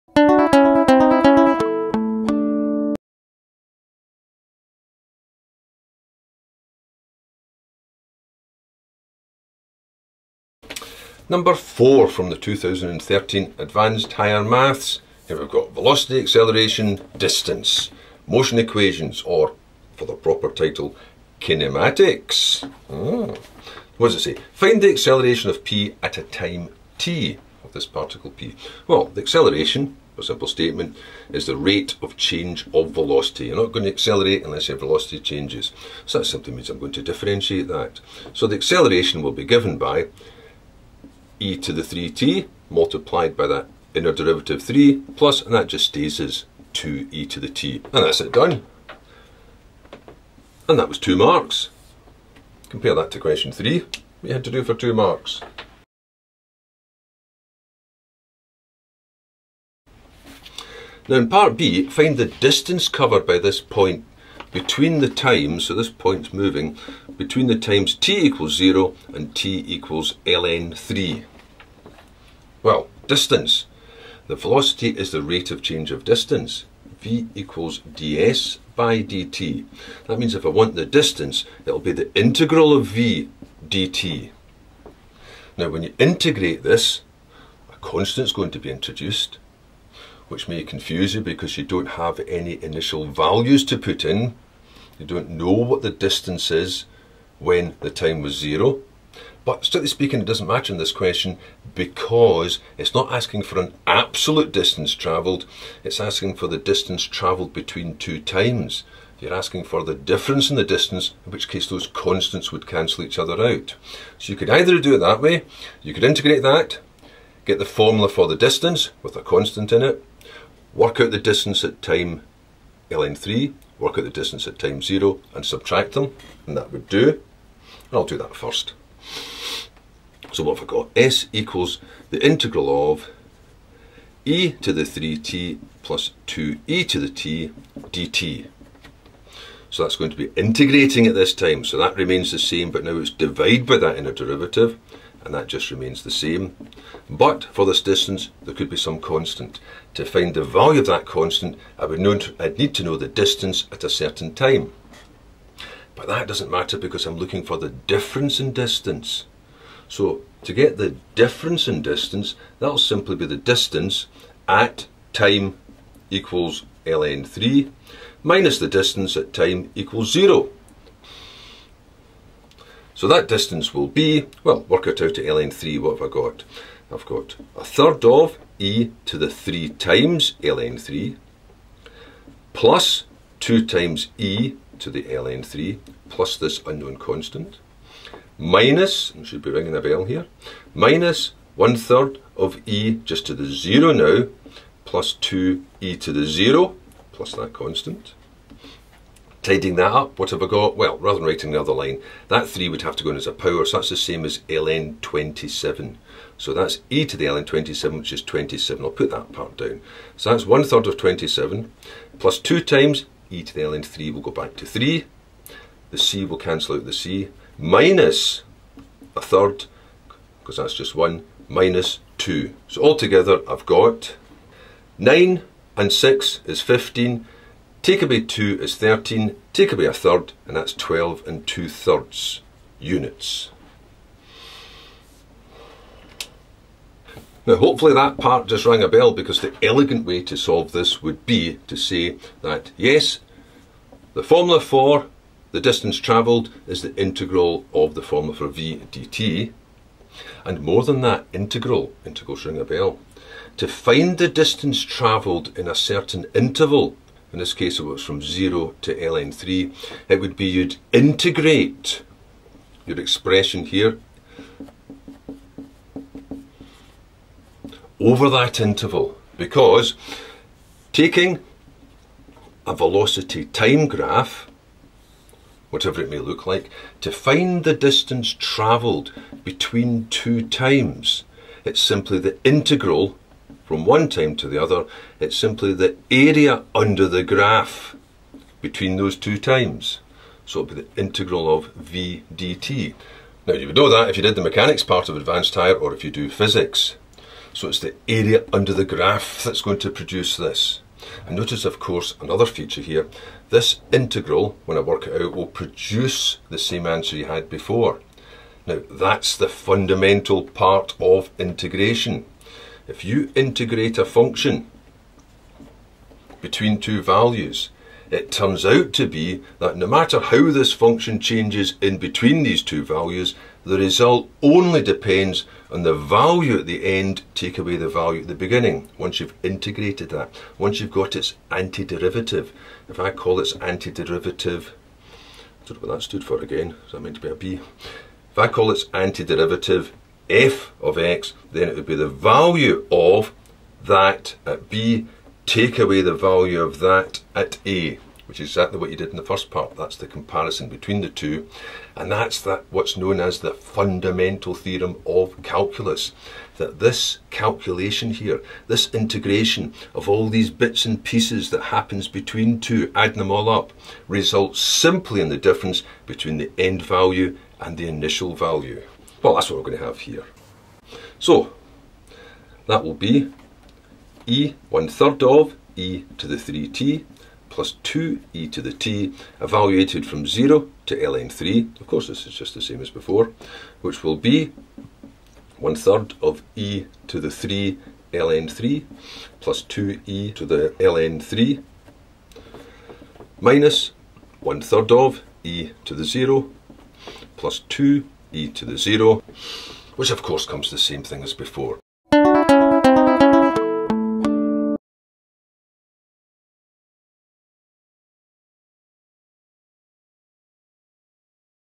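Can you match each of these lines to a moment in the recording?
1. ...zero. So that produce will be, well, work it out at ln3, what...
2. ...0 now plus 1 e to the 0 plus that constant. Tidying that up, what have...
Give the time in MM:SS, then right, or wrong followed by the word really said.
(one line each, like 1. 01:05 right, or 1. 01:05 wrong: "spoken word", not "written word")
1. 02:50 wrong: "distance", not "produce"
2. 03:13 wrong: "2", not "1".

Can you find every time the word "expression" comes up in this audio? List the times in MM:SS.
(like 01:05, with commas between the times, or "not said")
04:22.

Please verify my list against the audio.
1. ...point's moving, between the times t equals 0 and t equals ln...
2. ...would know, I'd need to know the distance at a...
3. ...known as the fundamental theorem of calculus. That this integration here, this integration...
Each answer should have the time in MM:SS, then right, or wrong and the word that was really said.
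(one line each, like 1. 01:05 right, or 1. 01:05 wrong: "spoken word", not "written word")
1. 01:05 right
2. 02:31 right
3. 05:52 wrong: "calculation", not "integration".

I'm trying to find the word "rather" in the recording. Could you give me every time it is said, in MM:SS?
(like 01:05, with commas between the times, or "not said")
03:20.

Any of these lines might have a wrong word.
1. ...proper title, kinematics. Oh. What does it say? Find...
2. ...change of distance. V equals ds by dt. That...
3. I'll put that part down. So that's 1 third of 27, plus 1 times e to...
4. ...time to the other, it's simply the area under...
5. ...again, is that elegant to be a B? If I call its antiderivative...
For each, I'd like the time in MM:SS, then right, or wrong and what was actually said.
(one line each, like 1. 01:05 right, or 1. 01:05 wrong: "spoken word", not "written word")
1. 00:20 right
2. 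01:15 right
3. 03:28 wrong: "2", not "1"
4. 04:44 right
5. 05:36 wrong: "meant", not "elegant".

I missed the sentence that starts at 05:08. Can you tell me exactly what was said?
Now, that's the fundamental part of integration.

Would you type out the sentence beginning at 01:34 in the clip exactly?
You don't know what the distance is when the time was zero.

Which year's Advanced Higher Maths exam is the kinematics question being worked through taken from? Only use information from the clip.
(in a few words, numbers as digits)
2013.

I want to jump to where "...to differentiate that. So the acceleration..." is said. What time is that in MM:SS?
00:36.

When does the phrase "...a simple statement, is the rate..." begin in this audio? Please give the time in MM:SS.
00:30.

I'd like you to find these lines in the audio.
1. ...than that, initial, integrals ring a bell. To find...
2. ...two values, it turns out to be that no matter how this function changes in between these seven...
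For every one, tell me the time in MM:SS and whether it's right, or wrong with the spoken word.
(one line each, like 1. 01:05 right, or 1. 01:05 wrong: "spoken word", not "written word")
1. 04:10 wrong: "integral", not "initial"
2. 05:16 wrong: "two", not "seven".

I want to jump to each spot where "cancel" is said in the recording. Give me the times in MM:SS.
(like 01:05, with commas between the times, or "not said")
01:52, 03:36.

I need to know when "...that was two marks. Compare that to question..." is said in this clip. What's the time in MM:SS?
00:50.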